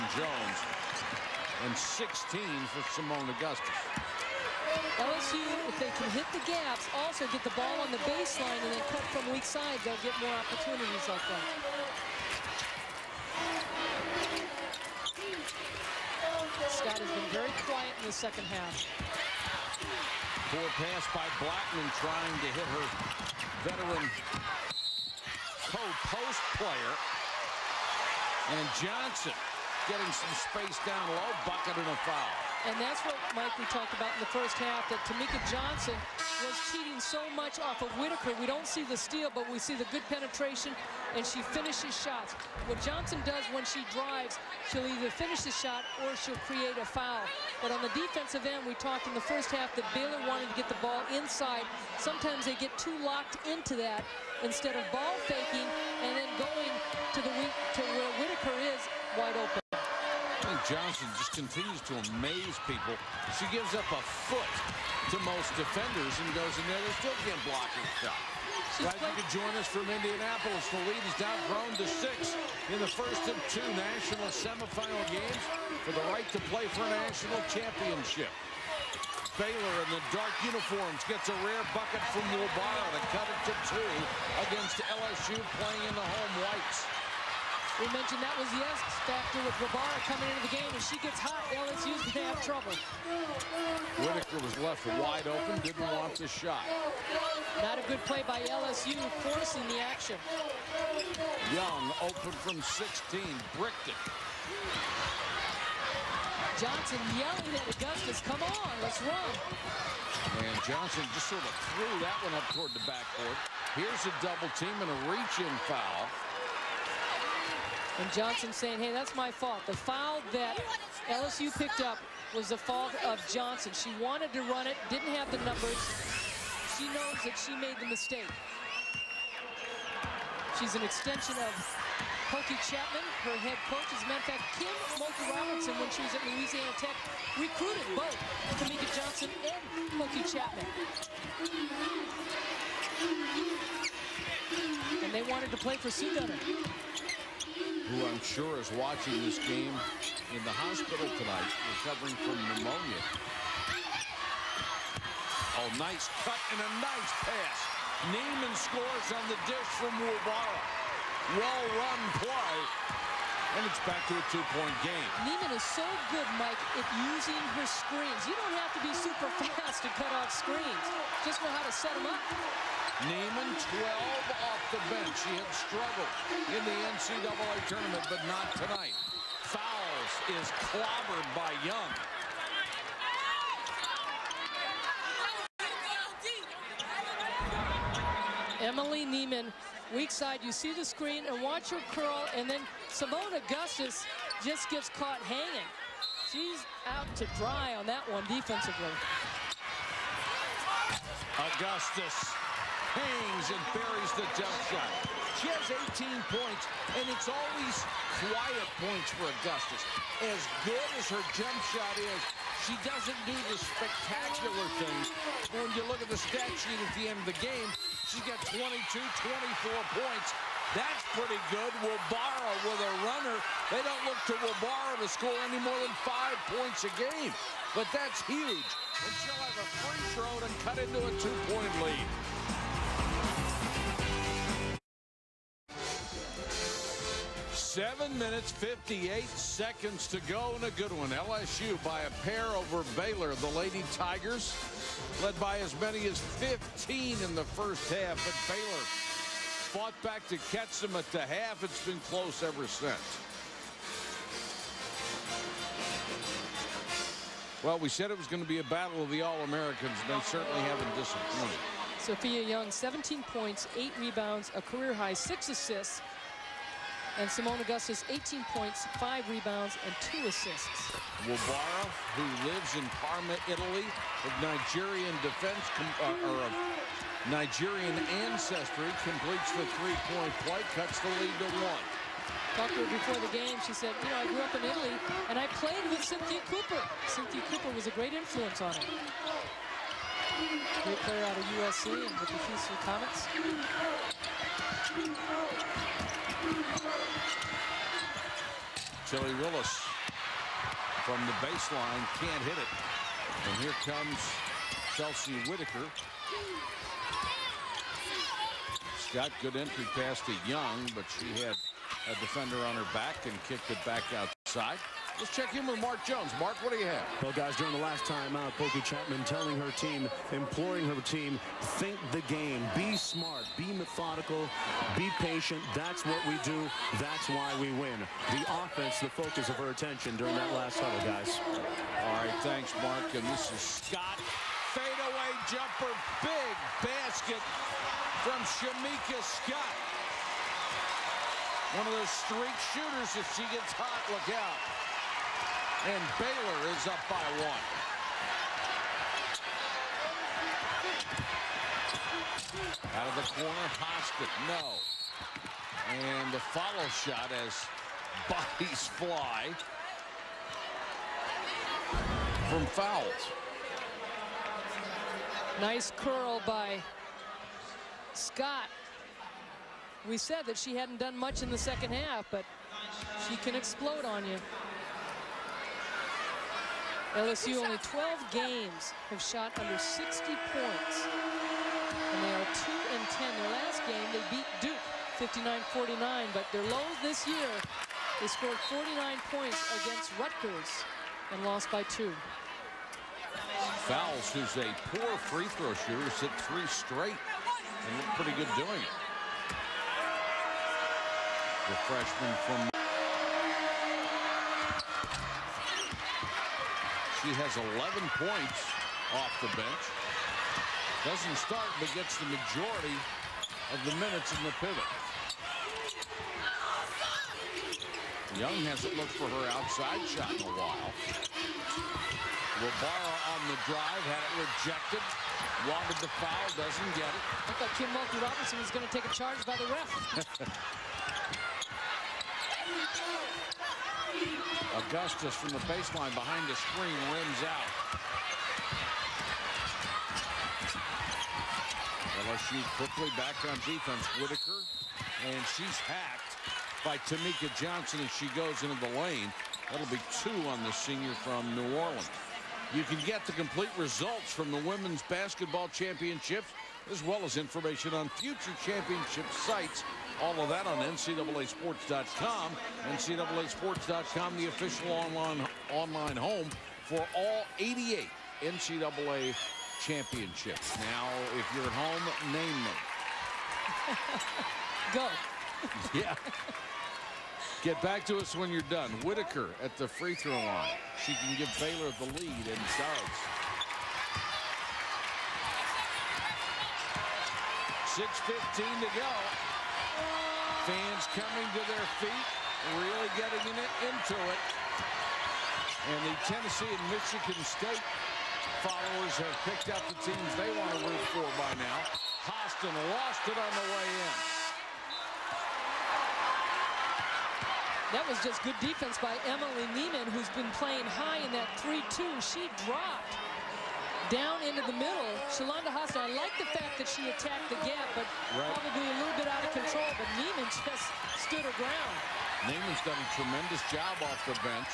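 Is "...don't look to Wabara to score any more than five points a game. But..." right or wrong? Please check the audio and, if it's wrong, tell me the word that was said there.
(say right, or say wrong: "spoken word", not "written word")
right.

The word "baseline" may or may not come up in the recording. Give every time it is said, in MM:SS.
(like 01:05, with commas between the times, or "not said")
00:08, 05:01, 07:15.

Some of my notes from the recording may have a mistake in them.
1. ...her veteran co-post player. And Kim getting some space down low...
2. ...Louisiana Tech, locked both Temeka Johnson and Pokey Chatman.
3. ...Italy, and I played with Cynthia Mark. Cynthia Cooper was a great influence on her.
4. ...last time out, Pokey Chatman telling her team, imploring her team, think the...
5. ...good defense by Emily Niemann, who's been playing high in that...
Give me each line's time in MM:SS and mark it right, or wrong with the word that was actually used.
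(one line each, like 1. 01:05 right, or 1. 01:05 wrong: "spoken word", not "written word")
1. 00:22 wrong: "Johnson", not "Kim"
2. 02:16 wrong: "recruited", not "locked"
3. 04:44 wrong: "Cooper", not "Mark"
4. 05:17 right
5. 08:28 right.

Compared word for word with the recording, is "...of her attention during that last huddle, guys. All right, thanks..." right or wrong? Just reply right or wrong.
right.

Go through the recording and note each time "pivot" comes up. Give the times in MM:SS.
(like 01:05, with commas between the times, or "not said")
06:54.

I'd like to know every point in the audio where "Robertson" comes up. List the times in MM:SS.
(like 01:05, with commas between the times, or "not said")
02:15, 07:08.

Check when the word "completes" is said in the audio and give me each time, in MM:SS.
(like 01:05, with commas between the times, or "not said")
04:39, 07:33.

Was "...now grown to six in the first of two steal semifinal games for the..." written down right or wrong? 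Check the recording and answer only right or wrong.
wrong.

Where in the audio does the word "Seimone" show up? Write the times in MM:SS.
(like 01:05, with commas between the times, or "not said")
00:03, 03:12, 04:27.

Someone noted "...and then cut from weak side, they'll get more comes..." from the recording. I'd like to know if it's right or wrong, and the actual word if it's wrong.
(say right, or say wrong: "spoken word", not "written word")
wrong: "opportunities", not "comes".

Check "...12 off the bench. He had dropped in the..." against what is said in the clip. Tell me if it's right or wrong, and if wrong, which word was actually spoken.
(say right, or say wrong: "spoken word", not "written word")
wrong: "struggled", not "dropped".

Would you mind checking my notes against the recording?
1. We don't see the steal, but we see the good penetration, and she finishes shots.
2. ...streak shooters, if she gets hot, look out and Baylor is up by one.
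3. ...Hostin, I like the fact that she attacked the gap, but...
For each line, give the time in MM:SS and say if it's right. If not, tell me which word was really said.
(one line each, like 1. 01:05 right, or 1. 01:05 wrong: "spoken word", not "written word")
1. 00:38 right
2. 05:42 right
3. 08:35 right.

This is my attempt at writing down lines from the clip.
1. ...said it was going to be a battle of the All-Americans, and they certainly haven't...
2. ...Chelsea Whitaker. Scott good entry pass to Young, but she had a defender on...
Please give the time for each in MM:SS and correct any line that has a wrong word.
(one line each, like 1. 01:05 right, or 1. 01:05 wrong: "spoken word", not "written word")
1. 04:17 right
2. 05:04 right.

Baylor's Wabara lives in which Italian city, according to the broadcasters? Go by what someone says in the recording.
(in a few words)
Parma.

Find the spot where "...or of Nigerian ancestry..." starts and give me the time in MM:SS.
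04:36.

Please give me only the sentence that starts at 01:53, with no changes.
Here's a double team and a reach-in foul.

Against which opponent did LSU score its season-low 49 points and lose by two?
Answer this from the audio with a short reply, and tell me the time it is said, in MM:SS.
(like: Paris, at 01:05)
Rutgers, at 06:30.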